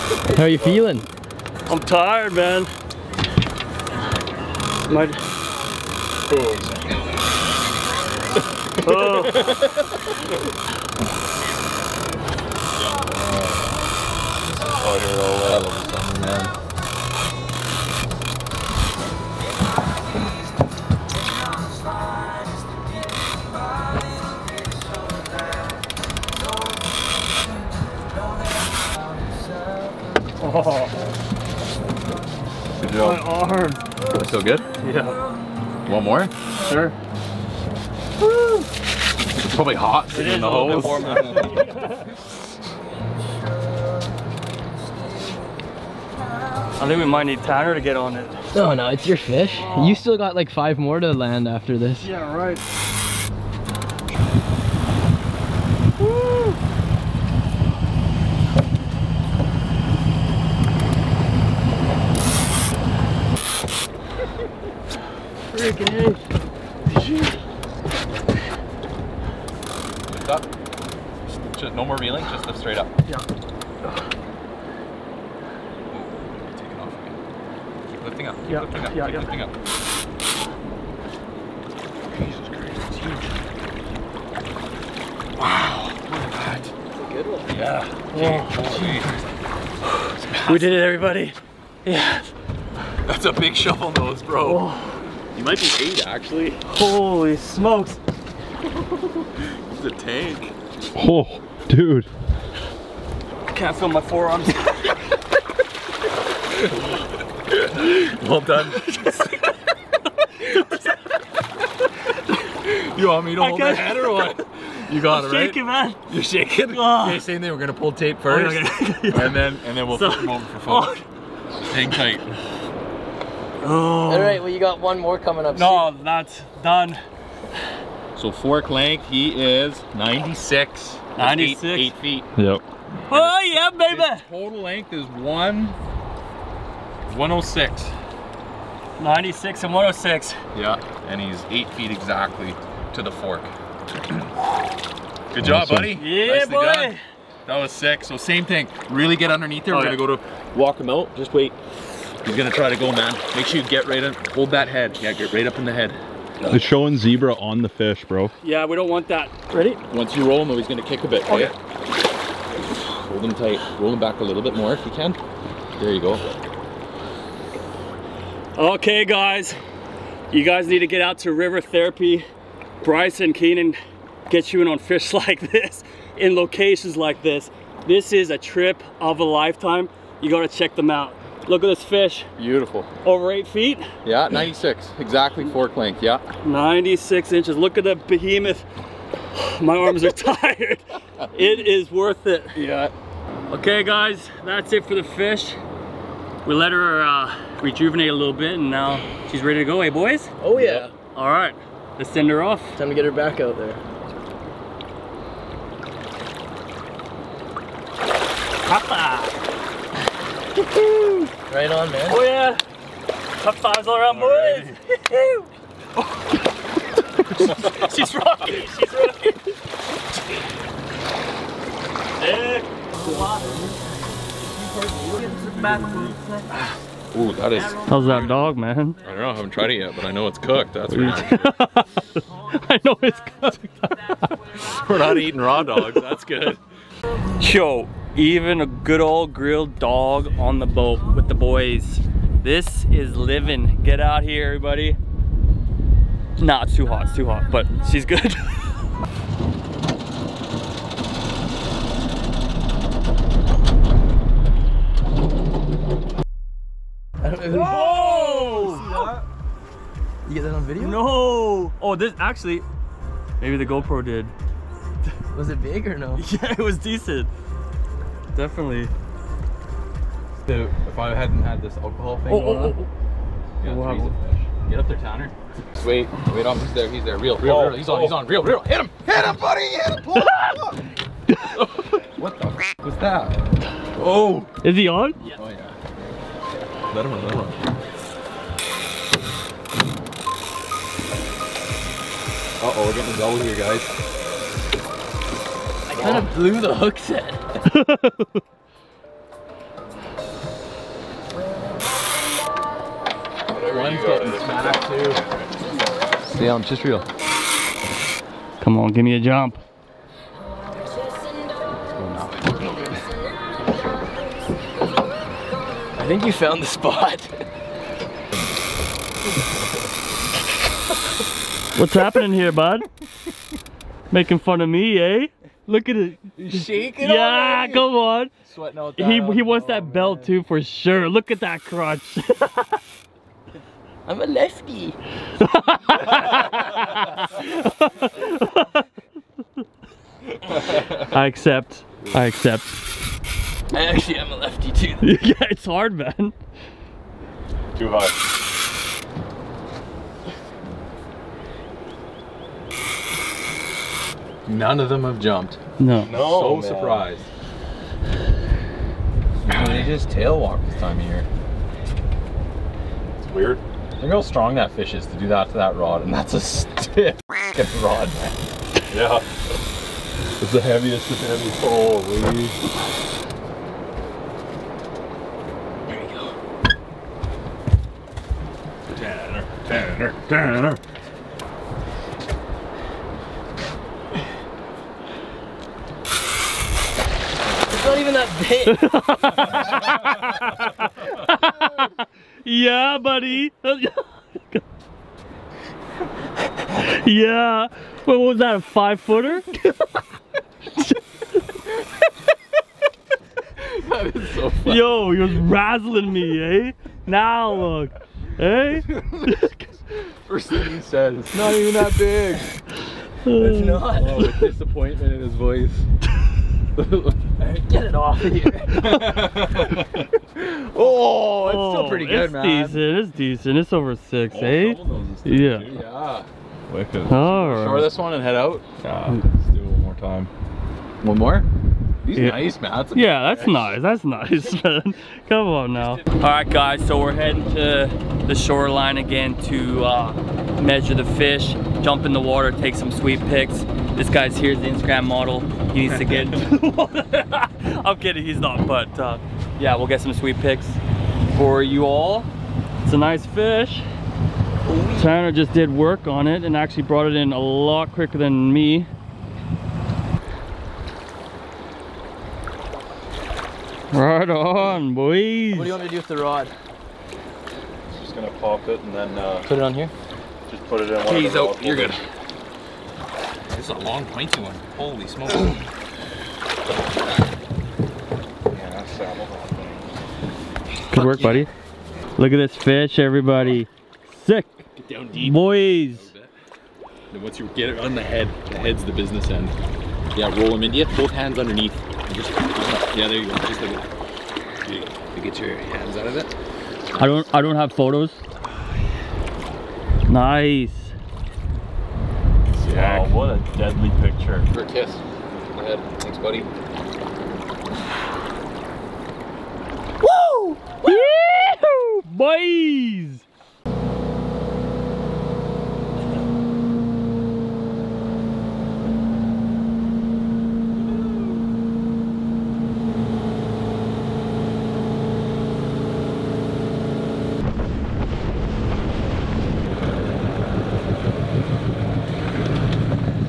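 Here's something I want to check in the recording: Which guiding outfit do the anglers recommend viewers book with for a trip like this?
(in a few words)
River Therapy.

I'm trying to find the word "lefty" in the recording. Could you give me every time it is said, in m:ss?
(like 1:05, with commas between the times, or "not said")
5:34, 5:44.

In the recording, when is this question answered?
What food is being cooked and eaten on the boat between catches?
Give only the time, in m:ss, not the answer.
3:59.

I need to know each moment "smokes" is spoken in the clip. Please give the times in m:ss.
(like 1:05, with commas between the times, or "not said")
1:37, 7:55.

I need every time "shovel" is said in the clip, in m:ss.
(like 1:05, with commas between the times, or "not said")
1:33.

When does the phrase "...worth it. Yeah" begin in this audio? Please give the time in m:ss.
3:11.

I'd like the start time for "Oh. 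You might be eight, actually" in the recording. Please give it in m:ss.
1:34.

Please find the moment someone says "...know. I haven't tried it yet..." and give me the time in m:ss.
3:49.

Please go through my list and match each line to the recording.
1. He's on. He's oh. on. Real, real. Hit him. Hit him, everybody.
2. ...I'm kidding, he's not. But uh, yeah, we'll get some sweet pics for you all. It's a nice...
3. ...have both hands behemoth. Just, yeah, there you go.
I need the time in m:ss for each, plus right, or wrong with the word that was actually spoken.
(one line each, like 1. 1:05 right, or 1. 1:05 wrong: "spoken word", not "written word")
1. 4:37 wrong: "buddy", not "everybody"
2. 7:27 right
3. 8:10 wrong: "underneath", not "behemoth".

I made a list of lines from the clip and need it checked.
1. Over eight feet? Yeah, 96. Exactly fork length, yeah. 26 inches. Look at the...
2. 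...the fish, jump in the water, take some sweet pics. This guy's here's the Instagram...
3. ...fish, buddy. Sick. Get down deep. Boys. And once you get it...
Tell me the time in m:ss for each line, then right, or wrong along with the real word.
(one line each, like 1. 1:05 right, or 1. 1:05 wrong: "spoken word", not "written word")
1. 3:03 wrong: "96", not "26"
2. 7:20 right
3. 8:02 wrong: "everybody", not "buddy".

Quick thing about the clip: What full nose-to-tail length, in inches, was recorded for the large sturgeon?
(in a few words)
106.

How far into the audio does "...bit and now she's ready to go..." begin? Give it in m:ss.
3:18.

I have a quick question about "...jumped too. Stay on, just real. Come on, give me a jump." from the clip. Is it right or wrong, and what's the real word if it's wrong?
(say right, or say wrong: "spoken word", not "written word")
wrong: "smacked", not "jumped".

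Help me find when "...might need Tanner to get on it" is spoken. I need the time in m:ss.
0:47.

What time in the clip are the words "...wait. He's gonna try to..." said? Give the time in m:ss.
2:31.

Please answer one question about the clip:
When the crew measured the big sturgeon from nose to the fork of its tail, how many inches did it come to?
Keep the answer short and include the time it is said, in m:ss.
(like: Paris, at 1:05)
96, at 2:08.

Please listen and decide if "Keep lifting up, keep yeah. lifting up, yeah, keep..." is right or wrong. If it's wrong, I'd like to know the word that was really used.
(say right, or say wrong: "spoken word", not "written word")
right.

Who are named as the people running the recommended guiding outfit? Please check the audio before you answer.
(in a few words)
Bryce and Keenan.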